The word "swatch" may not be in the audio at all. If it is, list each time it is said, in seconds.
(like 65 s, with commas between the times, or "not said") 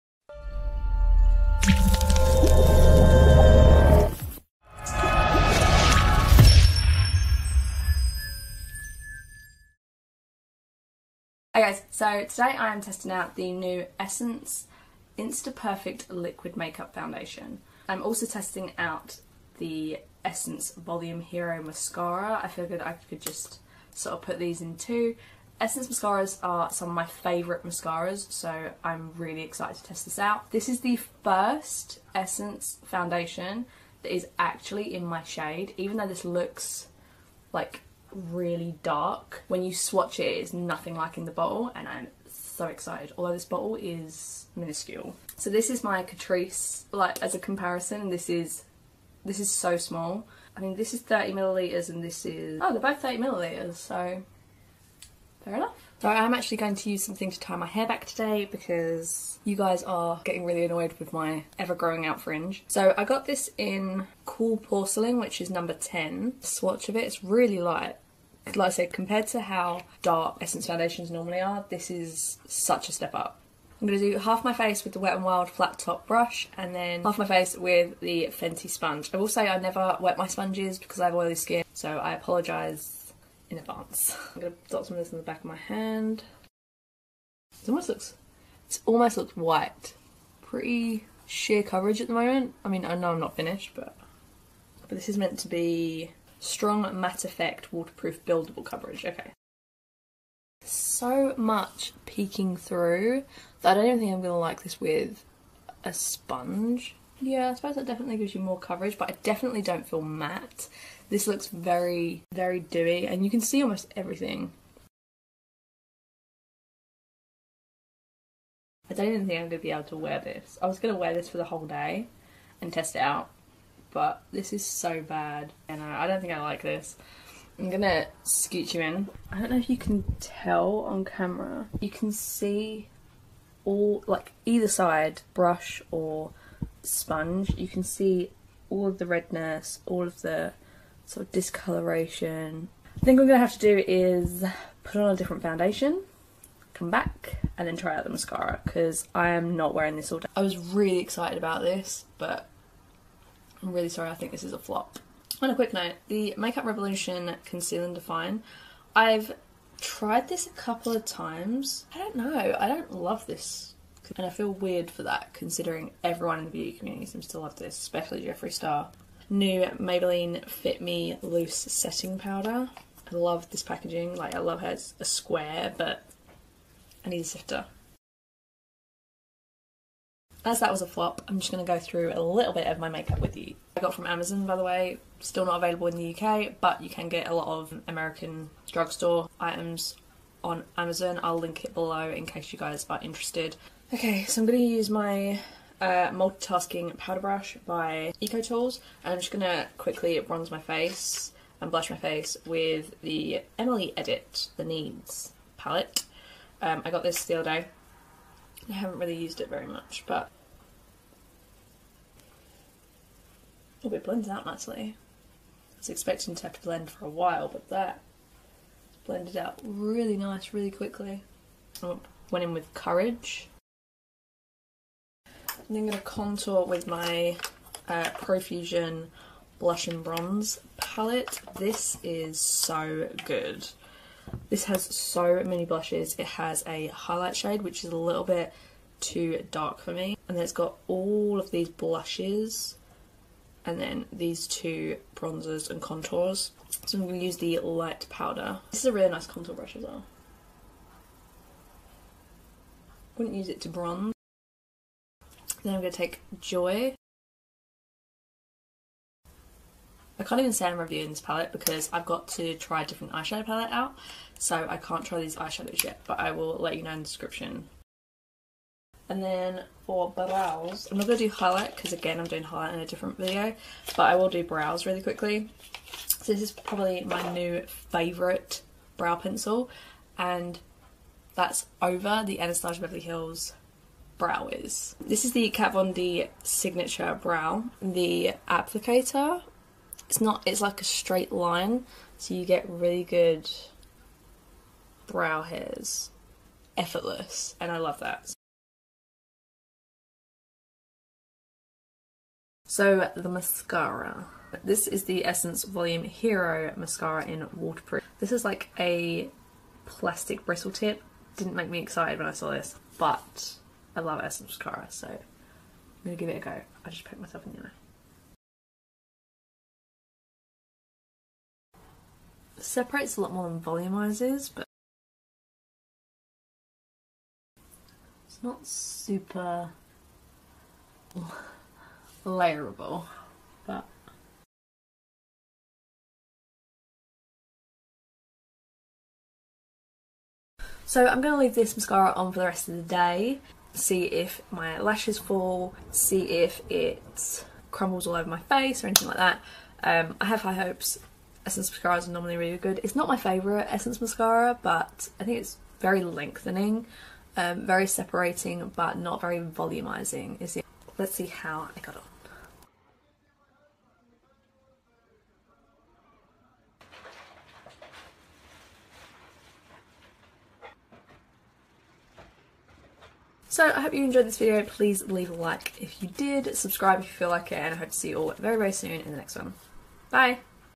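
39 s, 66 s.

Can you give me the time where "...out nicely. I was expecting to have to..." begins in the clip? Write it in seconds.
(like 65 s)
214 s.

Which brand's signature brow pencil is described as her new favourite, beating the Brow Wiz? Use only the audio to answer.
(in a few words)
Kat Von D.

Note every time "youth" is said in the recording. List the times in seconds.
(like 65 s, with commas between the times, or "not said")
not said.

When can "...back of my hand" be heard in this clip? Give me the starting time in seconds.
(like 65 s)
85 s.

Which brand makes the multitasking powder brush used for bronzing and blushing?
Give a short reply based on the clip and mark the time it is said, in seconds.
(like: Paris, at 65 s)
Eco Tools, at 198 s.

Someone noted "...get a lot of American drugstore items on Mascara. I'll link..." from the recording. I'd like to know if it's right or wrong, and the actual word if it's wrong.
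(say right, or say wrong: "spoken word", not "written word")
wrong: "Amazon", not "Mascara".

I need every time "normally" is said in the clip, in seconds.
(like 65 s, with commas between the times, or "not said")
71 s, 352 s.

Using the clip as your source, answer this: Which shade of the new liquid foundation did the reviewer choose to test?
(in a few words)
Cool Porcelain.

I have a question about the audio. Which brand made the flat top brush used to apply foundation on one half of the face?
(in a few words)
Wet n Wild.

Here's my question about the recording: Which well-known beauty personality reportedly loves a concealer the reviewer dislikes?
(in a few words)
Jeffree Star.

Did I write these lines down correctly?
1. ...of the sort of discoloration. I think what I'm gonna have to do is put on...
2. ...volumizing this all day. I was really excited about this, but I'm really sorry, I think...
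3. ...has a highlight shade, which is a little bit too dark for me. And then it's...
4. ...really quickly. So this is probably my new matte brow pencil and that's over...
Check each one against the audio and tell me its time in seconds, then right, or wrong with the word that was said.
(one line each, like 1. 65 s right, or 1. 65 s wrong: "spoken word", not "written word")
1. 140 s right
2. 149 s wrong: "wearing", not "volumizing"
3. 236 s right
4. 274 s wrong: "favourite", not "matte".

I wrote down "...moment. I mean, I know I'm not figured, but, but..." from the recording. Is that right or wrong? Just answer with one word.
wrong.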